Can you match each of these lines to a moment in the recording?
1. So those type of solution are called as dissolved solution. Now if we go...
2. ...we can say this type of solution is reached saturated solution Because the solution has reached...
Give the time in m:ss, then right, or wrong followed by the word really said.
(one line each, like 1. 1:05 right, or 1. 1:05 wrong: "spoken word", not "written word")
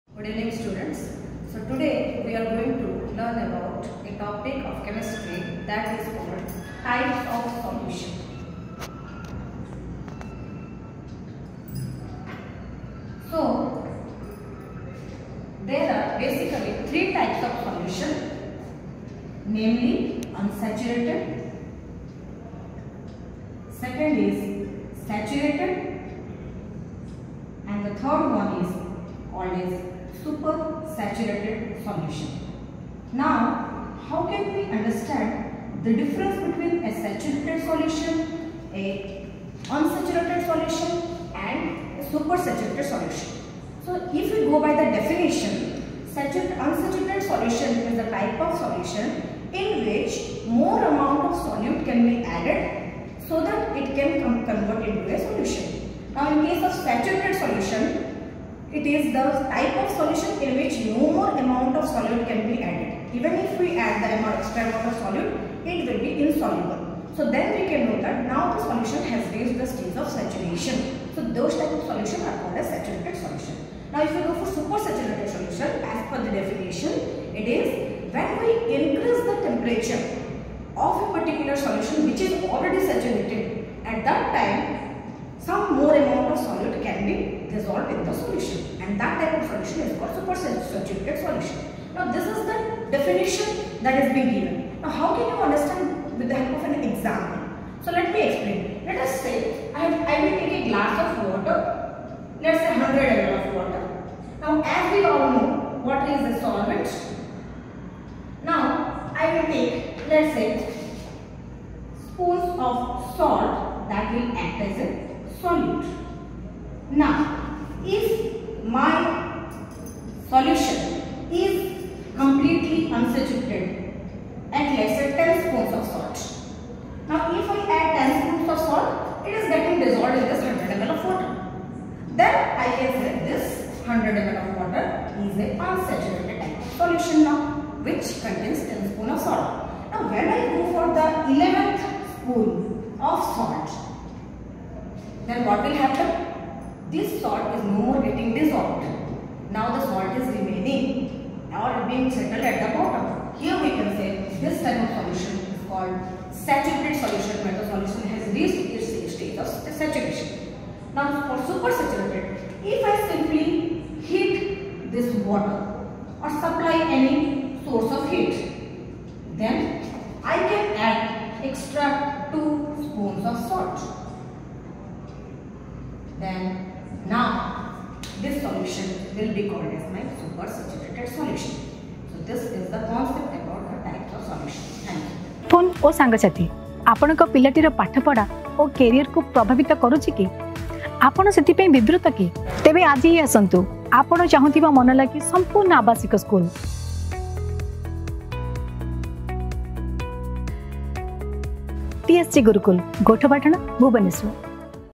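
1. 1:11 wrong: "saturated", not "dissolved"
2. 2:33 wrong: "called", not "reached".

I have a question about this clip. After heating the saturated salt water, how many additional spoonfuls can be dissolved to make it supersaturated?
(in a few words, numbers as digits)
2.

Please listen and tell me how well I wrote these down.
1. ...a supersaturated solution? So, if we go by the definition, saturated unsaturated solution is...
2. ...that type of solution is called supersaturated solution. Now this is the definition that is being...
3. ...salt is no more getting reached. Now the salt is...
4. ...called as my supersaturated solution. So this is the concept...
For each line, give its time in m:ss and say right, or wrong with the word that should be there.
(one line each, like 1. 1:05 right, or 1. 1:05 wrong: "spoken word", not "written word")
1. 0:42 right
2. 1:28 right
3. 2:27 wrong: "dissolved", not "reached"
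4. 2:59 right.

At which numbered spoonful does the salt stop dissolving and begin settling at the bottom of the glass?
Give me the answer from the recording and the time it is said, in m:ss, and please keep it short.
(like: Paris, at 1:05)
11th, at 2:21.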